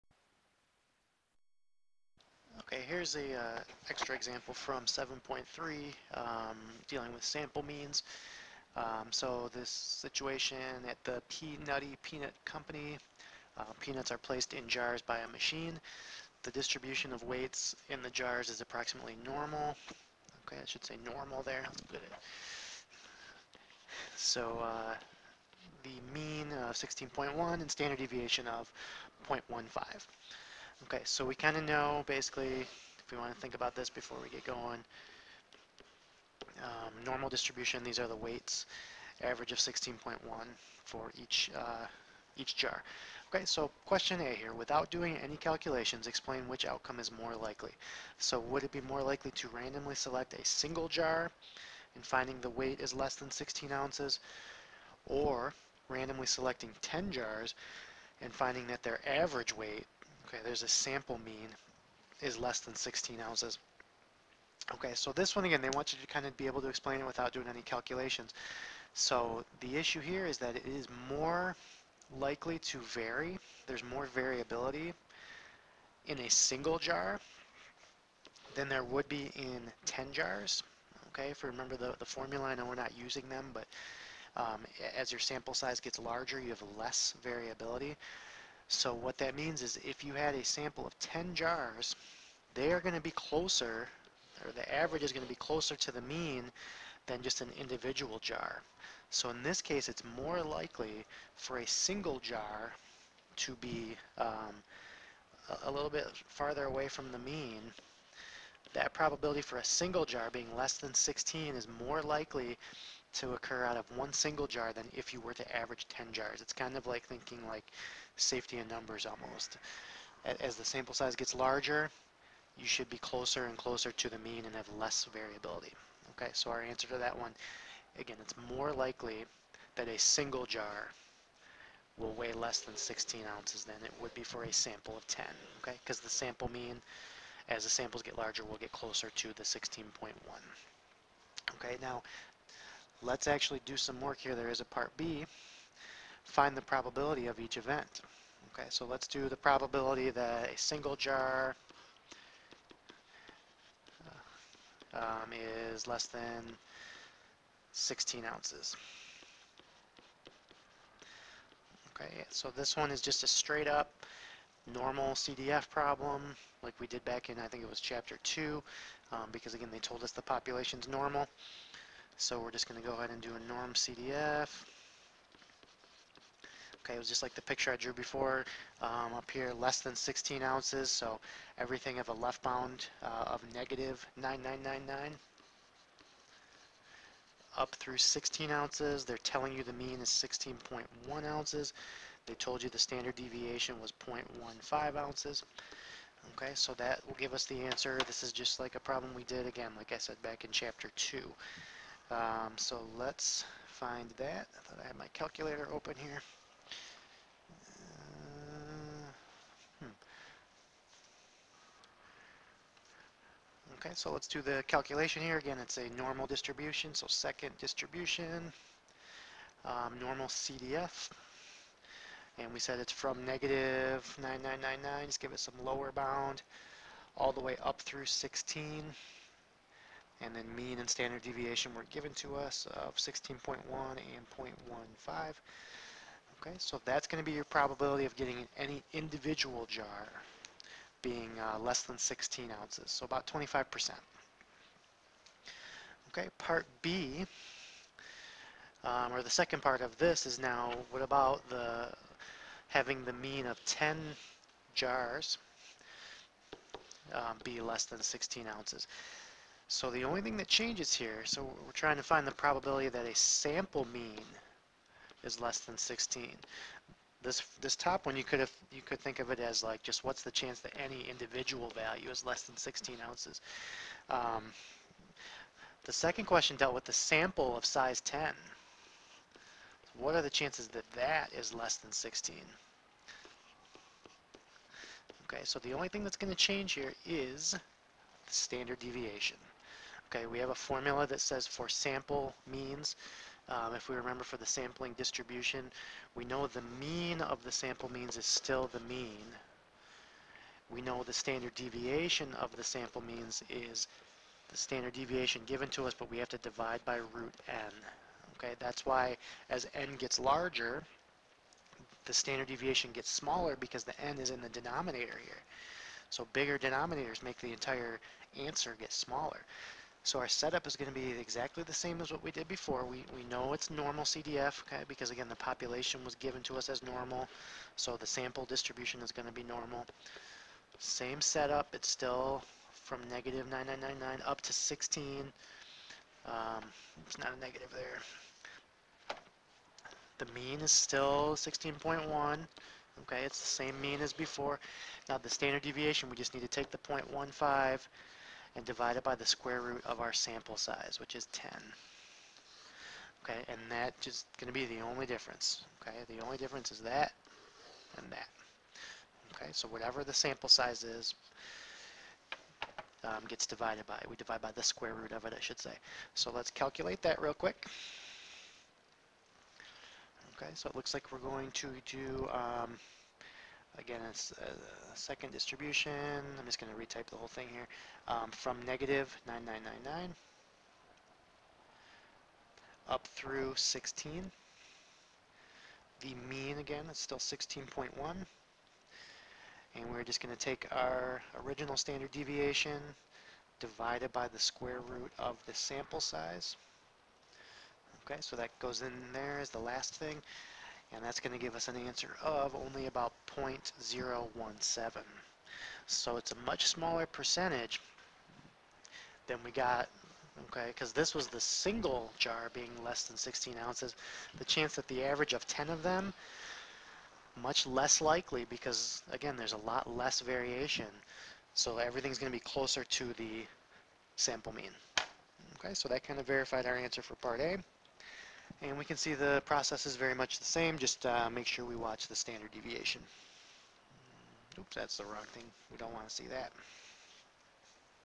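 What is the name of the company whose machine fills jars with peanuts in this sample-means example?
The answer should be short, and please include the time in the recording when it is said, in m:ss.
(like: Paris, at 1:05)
P. Nutty Peanut Company, at 0:11.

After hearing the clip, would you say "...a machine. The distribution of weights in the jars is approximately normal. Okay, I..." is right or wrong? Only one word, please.
right.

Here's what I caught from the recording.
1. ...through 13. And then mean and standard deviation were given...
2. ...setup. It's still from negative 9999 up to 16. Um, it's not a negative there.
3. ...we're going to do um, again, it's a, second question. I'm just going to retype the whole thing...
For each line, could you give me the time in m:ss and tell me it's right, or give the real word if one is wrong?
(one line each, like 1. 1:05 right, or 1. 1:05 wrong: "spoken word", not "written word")
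1. 3:47 wrong: "16", not "13"
2. 5:31 right
3. 6:11 wrong: "distribution", not "question".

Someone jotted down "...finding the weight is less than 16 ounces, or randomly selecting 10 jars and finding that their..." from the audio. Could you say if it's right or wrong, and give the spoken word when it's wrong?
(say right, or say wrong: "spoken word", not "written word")
right.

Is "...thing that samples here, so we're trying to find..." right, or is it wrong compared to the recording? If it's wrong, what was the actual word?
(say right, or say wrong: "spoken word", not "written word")
wrong: "changes", not "samples".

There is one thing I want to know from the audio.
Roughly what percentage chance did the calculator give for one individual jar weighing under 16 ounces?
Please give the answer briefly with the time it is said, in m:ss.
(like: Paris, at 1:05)
25%, at 4:03.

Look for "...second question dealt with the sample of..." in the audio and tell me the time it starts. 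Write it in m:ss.
4:35.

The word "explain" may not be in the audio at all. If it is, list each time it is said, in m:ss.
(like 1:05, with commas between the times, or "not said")
0:46, 1:06.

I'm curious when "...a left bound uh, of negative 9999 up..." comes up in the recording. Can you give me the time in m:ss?
3:02.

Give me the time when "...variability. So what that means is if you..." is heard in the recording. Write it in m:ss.
1:27.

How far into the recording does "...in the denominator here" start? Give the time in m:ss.
5:14.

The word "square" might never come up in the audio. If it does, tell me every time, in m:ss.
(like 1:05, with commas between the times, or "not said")
5:49, 6:04, 6:34.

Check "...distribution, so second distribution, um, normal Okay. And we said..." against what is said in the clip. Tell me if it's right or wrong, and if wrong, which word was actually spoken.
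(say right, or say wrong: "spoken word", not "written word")
wrong: "CDF", not "Okay".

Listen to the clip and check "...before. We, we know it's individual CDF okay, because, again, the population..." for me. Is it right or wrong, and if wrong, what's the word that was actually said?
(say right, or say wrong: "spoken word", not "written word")
wrong: "normal", not "individual".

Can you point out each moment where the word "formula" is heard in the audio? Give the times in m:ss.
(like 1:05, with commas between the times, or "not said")
1:22, 4:50.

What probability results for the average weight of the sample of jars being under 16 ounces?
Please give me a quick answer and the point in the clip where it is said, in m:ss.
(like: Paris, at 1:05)
0.017, at 6:43.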